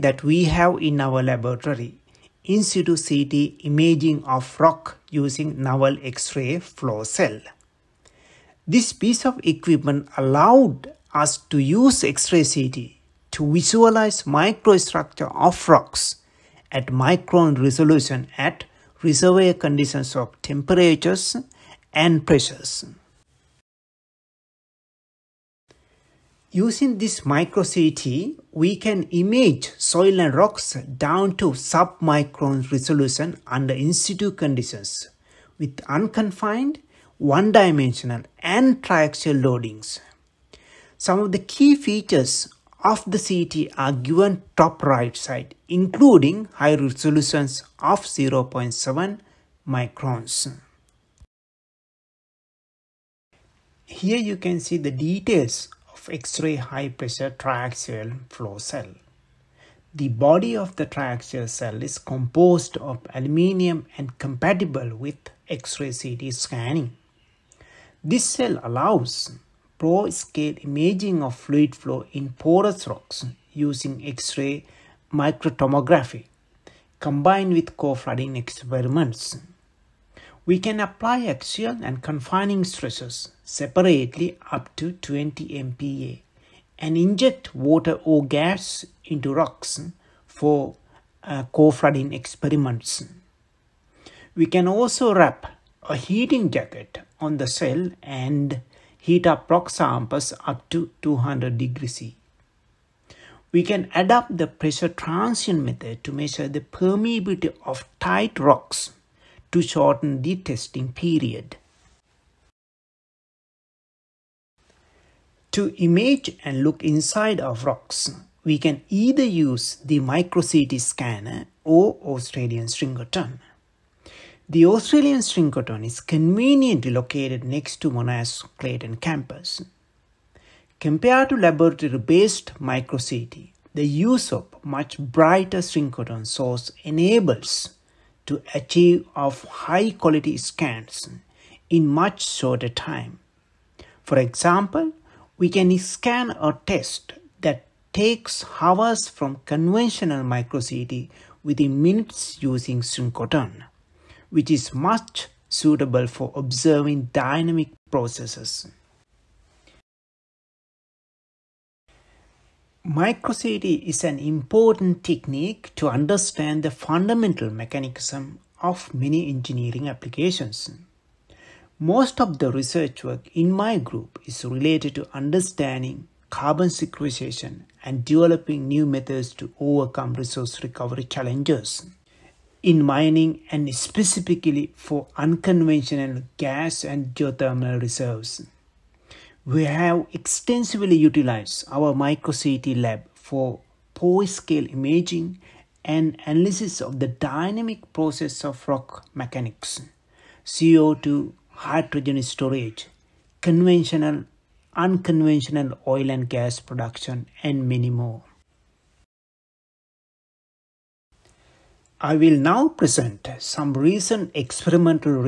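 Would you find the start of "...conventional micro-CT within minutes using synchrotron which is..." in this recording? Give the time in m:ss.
2:29.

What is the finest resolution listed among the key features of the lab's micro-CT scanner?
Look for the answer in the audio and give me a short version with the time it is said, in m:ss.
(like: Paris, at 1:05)
0.7 microns, at 0:48.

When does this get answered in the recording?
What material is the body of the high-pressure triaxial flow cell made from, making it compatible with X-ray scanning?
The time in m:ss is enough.
1:03.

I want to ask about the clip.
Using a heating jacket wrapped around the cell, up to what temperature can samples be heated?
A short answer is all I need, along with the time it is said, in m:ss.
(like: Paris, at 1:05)
200 degrees C, at 1:41.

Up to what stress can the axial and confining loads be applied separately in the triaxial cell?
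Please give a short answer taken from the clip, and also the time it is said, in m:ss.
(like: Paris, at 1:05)
20 MPa, at 1:24.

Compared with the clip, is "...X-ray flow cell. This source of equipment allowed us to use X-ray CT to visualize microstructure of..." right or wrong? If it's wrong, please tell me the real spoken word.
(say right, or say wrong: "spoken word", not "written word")
wrong: "piece", not "source".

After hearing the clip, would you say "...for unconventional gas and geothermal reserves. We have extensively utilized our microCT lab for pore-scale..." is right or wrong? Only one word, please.
right.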